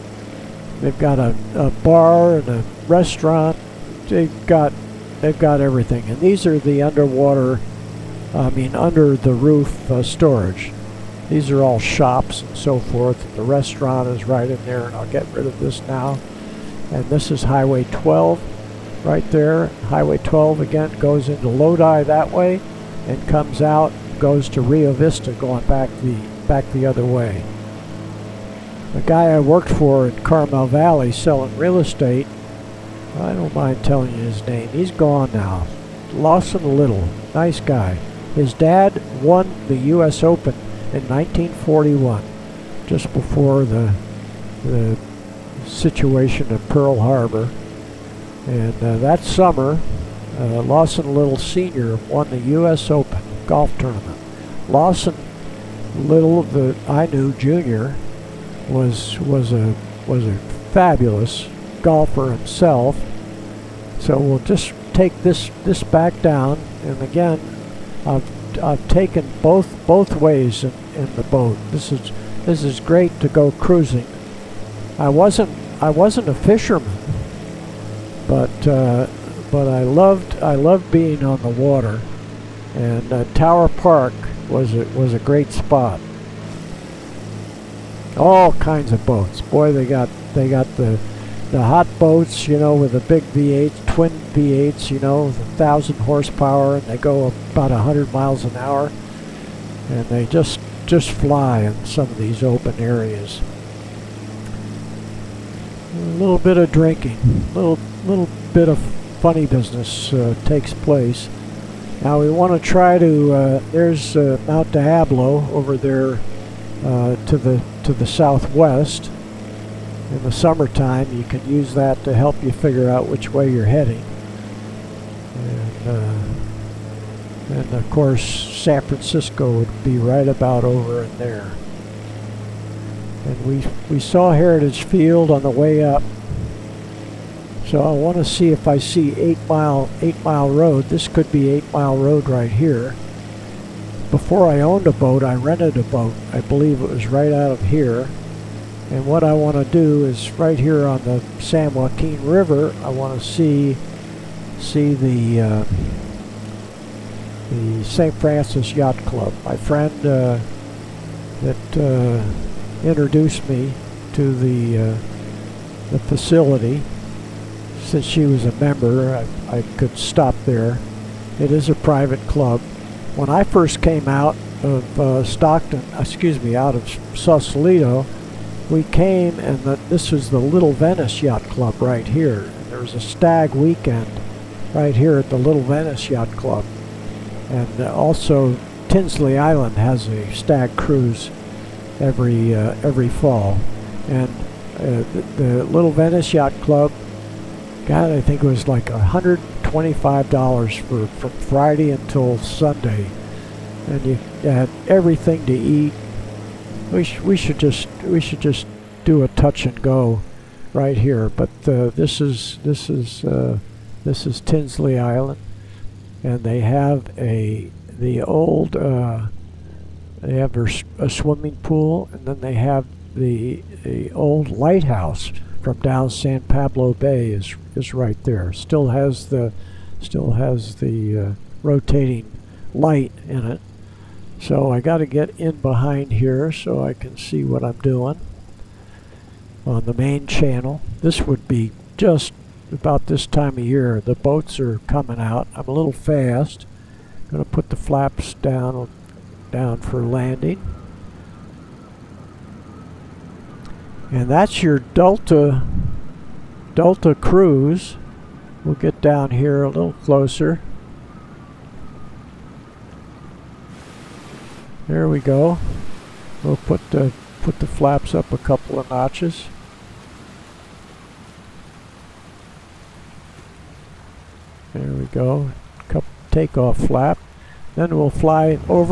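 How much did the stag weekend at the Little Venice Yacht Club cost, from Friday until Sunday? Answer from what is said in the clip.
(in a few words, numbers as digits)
$125.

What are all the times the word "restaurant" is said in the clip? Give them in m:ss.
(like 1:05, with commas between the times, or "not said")
0:02, 0:13.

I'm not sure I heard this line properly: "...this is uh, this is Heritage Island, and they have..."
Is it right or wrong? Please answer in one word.
wrong.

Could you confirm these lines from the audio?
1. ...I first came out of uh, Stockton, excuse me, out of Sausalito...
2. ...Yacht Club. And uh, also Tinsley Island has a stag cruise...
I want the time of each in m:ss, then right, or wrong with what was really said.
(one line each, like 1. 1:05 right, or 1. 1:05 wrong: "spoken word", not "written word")
1. 2:53 right
2. 3:06 right.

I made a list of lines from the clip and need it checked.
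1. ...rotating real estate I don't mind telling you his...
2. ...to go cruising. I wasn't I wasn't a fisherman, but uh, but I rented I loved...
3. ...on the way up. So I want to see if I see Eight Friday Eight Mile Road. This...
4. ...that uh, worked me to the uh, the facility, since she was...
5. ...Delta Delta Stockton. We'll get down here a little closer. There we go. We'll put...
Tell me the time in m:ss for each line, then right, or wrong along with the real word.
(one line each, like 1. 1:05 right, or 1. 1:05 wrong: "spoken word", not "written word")
1. 0:31 wrong: "selling", not "rotating"
2. 1:13 wrong: "loved", not "rented"
3. 2:15 wrong: "Mile", not "Friday"
4. 2:41 wrong: "introduced", not "worked"
5. 4:14 wrong: "Cruise", not "Stockton".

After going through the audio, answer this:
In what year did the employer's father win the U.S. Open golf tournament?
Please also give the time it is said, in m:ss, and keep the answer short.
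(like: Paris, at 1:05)
1941, at 0:41.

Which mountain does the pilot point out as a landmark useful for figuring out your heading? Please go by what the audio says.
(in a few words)
Mount Diablo.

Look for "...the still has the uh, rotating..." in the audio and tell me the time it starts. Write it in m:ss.
3:49.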